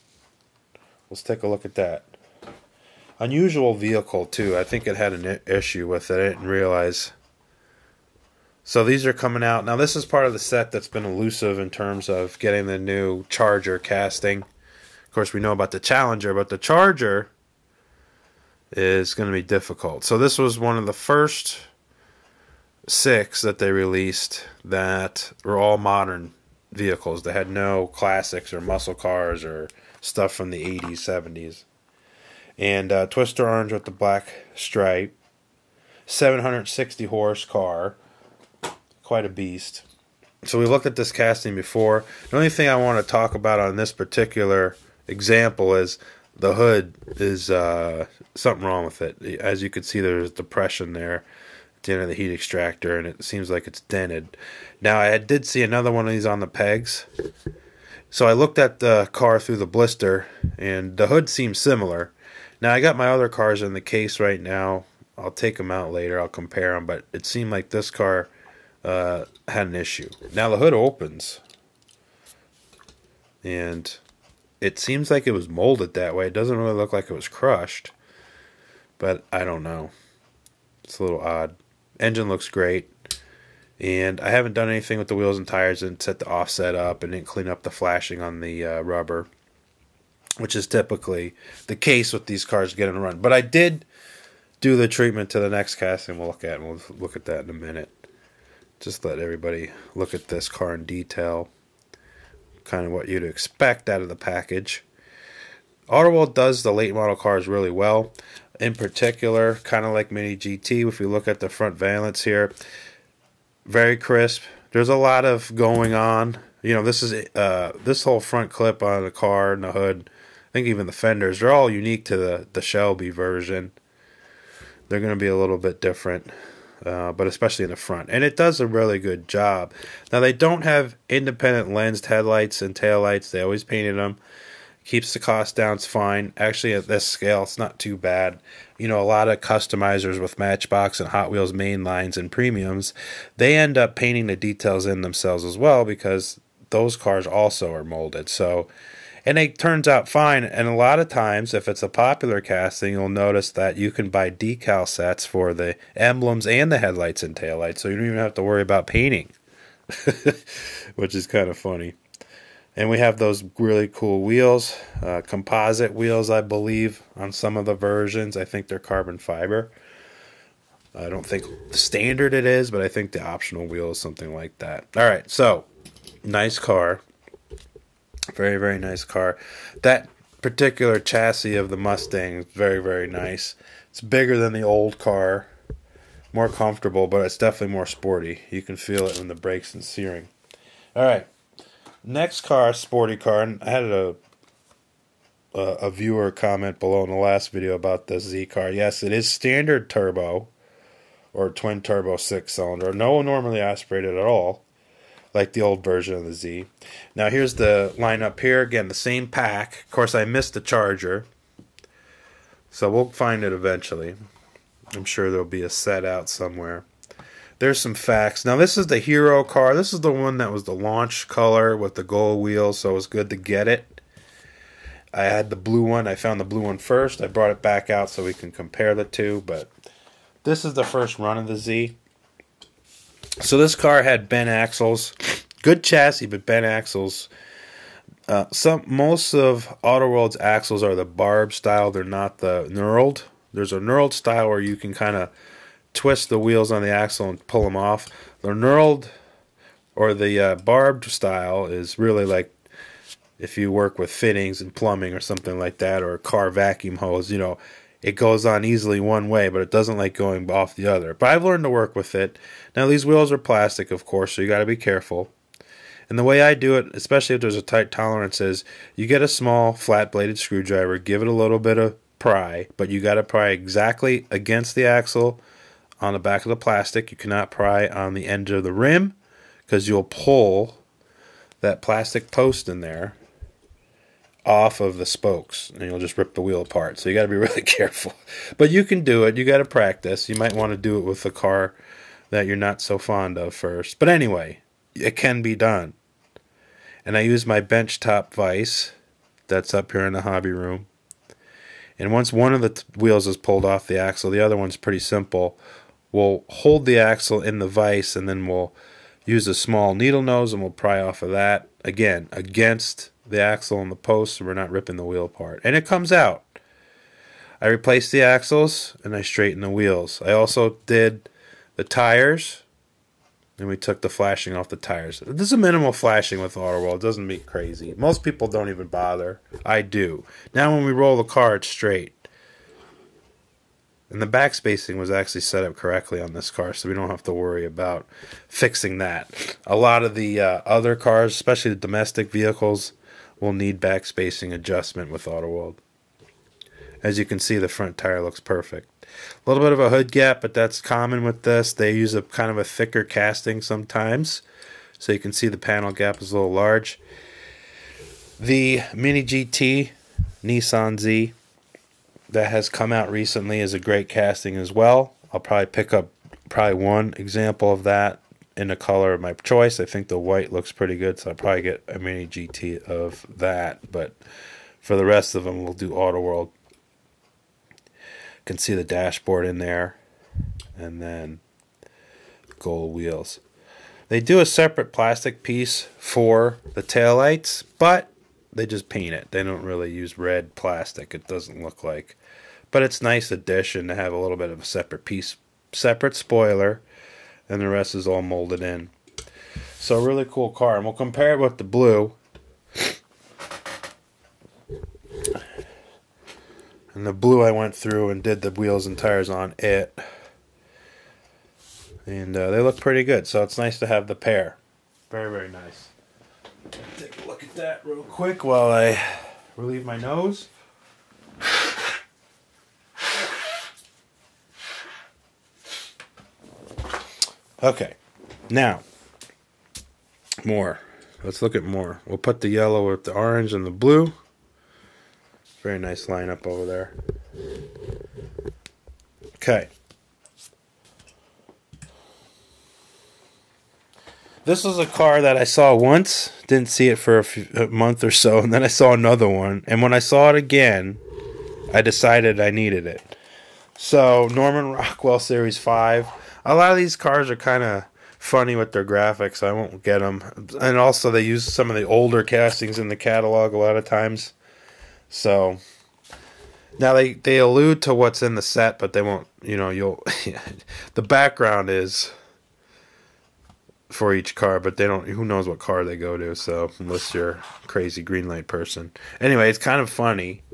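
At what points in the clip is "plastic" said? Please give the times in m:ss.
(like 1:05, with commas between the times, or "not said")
4:23, 4:36, 4:41, 6:24, 6:30.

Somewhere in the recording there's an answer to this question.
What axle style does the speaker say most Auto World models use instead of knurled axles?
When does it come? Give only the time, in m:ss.
4:01.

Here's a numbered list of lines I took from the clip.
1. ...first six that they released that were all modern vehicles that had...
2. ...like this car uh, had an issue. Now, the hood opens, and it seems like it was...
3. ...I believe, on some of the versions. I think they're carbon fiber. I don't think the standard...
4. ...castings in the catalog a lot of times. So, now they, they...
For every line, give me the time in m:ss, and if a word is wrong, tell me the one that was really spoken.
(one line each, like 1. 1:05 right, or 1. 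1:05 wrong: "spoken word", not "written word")
1. 0:20 right
2. 1:07 right
3. 2:46 right
4. 7:42 right.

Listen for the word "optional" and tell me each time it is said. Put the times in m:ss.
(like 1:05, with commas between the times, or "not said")
2:53.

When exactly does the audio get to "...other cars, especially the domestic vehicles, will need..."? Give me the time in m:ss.
5:40.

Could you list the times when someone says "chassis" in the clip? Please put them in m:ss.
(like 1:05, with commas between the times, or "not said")
3:00, 3:55.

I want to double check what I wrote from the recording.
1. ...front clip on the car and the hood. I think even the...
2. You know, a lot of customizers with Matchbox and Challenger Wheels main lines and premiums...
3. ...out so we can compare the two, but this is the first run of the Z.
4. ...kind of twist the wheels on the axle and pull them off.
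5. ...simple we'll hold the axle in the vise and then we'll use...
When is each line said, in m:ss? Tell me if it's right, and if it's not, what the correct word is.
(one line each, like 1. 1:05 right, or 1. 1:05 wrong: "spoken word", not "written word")
1. 1:58 right
2. 2:18 wrong: "Hot", not "Challenger"
3. 3:47 right
4. 4:04 right
5. 5:05 right.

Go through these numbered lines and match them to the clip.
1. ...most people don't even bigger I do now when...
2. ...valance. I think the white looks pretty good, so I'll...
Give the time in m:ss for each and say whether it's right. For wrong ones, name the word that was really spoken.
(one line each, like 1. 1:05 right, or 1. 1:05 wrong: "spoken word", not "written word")
1. 5:27 wrong: "bother", not "bigger"
2. 6:09 wrong: "choice", not "valance".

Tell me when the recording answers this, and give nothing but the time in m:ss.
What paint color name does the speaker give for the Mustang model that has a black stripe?
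0:33.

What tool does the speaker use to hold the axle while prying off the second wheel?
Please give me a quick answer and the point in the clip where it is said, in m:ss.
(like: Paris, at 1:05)
bench top vise, at 4:57.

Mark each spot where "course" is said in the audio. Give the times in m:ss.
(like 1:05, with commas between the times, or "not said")
0:15, 3:29, 4:24.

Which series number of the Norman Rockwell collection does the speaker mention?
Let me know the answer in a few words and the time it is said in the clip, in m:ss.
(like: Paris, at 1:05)
5, at 7:35.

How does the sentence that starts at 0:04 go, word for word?
I think it had an issue with it.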